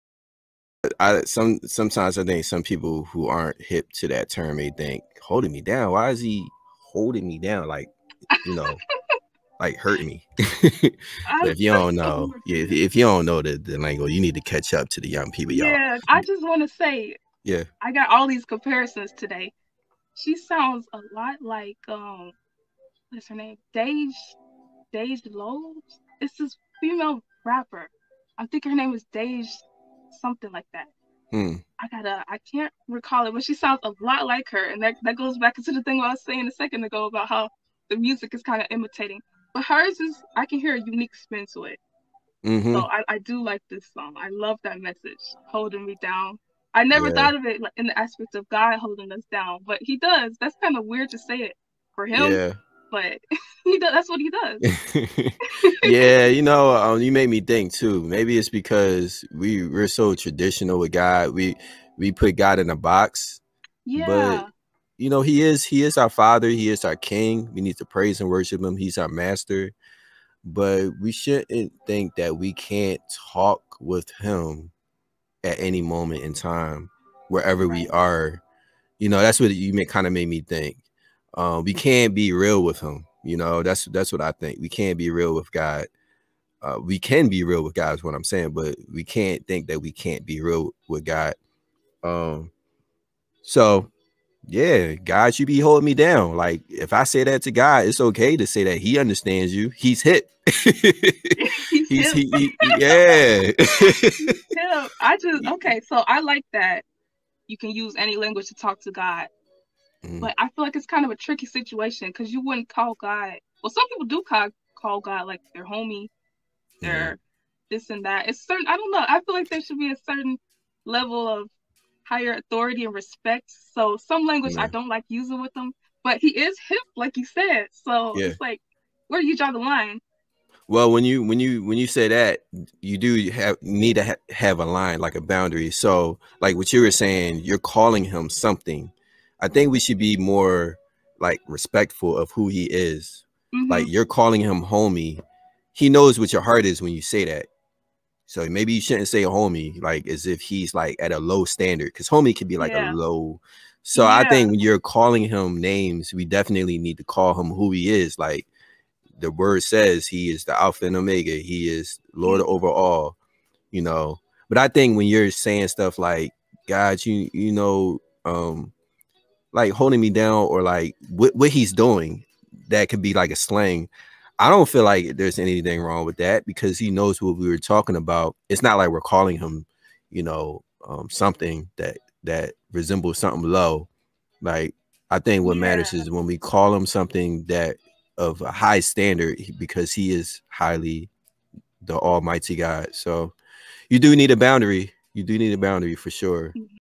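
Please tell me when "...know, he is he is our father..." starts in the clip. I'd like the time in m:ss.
1:05.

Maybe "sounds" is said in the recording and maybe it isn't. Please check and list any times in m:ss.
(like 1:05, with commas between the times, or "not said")
0:20, 0:33.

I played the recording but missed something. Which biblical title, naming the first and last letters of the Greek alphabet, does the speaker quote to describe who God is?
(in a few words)
Alpha and Omega.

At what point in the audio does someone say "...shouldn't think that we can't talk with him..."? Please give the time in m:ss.
1:11.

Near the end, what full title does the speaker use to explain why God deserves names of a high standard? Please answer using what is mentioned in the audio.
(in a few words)
Almighty God.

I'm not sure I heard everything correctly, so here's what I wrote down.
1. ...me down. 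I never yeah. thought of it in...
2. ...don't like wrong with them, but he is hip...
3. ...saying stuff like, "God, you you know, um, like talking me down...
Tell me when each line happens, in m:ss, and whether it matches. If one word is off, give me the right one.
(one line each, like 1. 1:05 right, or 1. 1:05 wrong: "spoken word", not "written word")
1. 0:45 right
2. 2:04 wrong: "using", not "wrong"
3. 2:45 wrong: "holding", not "talking".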